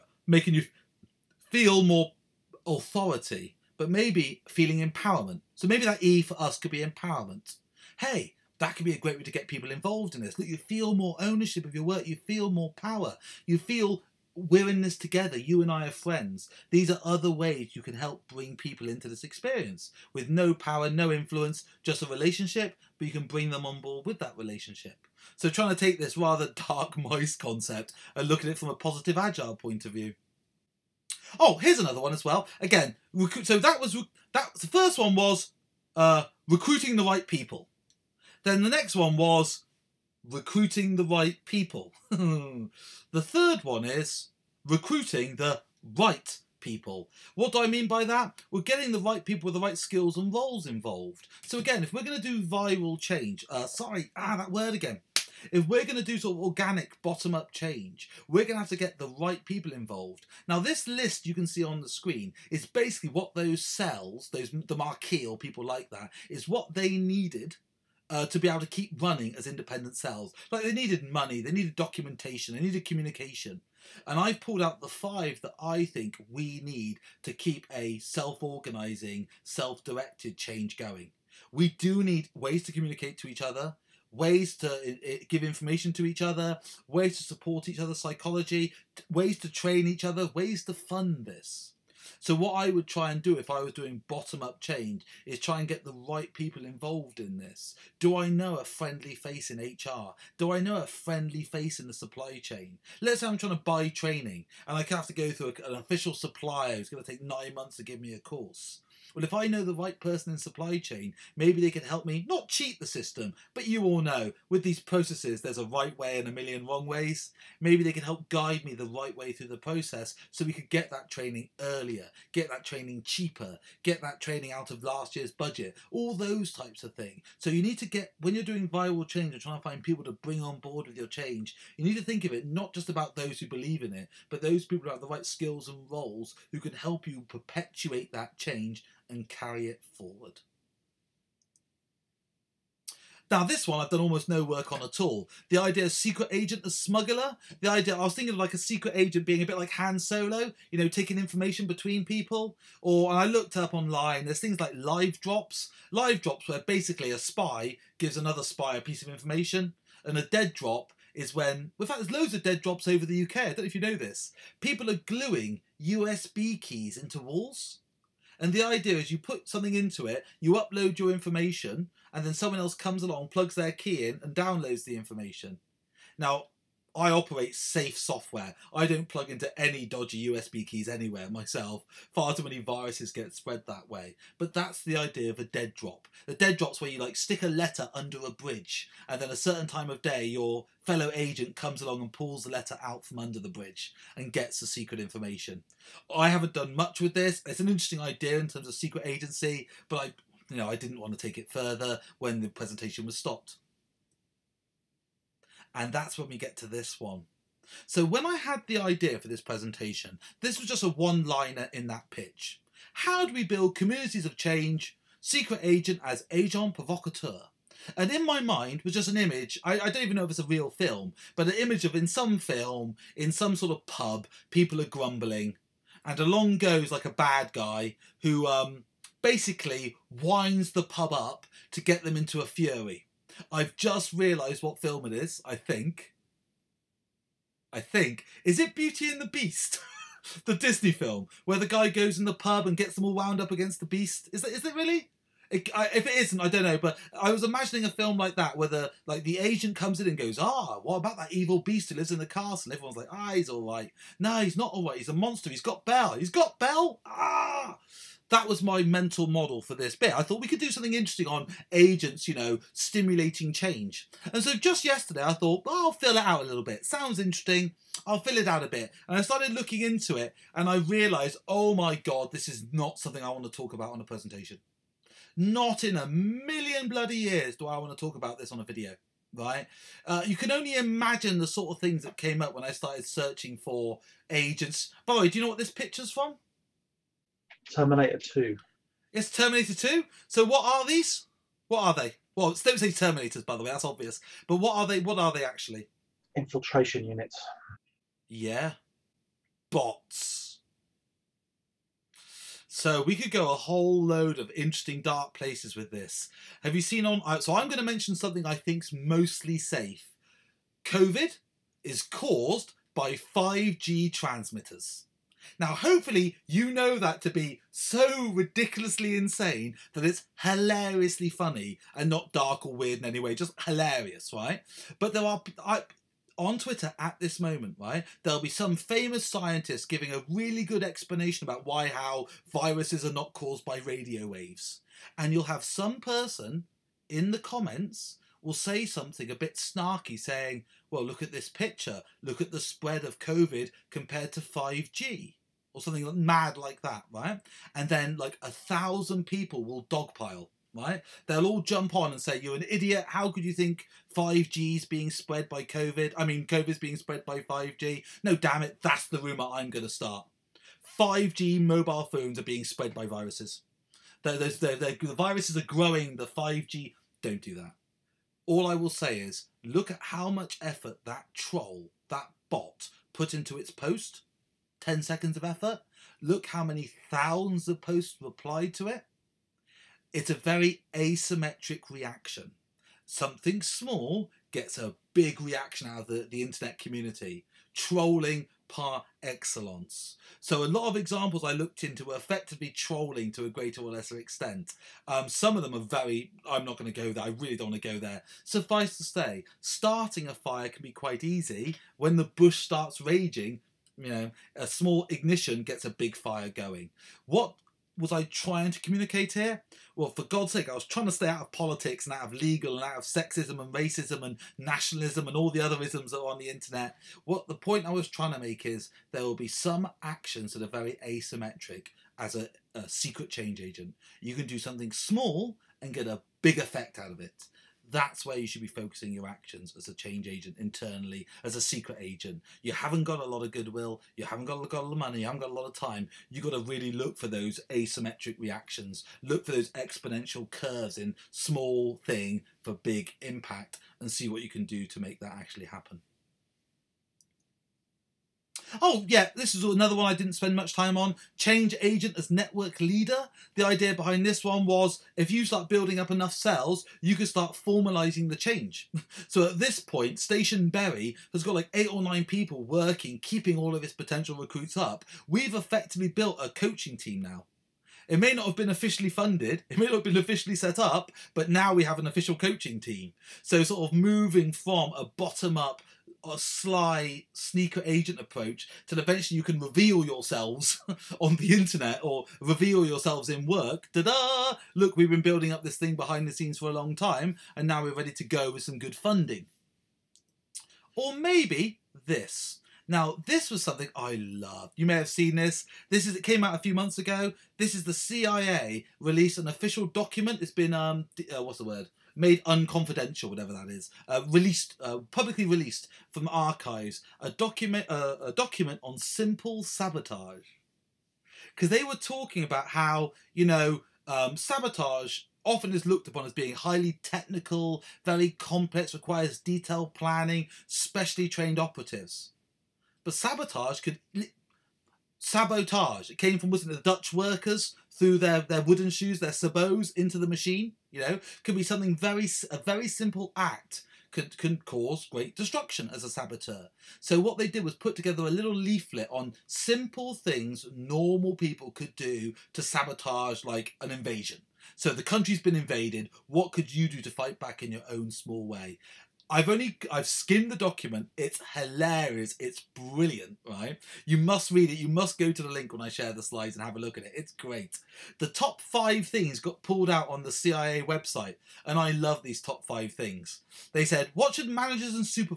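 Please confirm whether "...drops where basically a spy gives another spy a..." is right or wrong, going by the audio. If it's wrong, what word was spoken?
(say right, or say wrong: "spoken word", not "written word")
right.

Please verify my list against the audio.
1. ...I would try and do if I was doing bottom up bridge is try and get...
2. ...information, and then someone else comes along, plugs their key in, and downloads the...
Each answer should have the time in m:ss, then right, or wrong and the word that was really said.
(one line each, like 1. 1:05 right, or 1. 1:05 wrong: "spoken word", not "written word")
1. 1:32 wrong: "change", not "bridge"
2. 2:51 right.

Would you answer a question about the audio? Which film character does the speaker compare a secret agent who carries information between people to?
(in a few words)
Han Solo.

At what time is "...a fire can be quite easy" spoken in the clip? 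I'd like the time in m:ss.
6:40.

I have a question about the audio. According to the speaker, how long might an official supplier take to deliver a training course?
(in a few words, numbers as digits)
9 months.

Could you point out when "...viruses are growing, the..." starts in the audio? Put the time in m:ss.
6:05.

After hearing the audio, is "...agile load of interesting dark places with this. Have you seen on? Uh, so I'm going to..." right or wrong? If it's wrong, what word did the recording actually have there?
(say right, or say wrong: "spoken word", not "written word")
wrong: "whole", not "agile".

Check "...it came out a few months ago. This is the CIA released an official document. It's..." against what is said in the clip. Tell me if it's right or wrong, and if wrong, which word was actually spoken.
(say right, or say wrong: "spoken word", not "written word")
right.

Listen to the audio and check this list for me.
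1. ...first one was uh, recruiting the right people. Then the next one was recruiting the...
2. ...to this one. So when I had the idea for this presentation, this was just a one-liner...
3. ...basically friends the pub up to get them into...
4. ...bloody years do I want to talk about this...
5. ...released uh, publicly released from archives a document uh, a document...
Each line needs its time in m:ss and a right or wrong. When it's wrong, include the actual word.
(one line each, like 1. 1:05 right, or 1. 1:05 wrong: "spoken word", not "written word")
1. 0:34 right
2. 3:26 right
3. 3:49 wrong: "winds", not "friends"
4. 4:36 right
5. 8:24 right.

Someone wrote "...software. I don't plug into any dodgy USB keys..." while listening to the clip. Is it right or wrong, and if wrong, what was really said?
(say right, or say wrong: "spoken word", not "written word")
right.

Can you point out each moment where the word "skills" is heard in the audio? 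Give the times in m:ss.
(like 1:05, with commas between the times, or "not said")
0:49, 2:15.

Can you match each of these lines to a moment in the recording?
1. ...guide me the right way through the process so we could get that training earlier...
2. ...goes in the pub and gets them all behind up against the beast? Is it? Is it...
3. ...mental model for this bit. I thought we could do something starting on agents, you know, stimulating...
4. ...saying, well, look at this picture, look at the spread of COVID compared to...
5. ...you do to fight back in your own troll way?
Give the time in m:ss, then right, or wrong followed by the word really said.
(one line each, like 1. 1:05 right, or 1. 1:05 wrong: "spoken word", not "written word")
1. 1:58 right
2. 4:01 wrong: "wound", not "behind"
3. 4:18 wrong: "interesting", not "starting"
4. 5:40 right
5. 9:06 wrong: "small", not "troll".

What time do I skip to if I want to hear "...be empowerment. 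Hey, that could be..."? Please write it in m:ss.
0:06.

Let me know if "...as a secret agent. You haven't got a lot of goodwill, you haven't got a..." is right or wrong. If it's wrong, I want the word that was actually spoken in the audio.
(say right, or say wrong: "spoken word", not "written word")
right.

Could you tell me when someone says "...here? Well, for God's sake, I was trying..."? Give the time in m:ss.
6:49.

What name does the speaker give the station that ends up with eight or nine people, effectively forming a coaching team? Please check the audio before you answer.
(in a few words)
Station Berry.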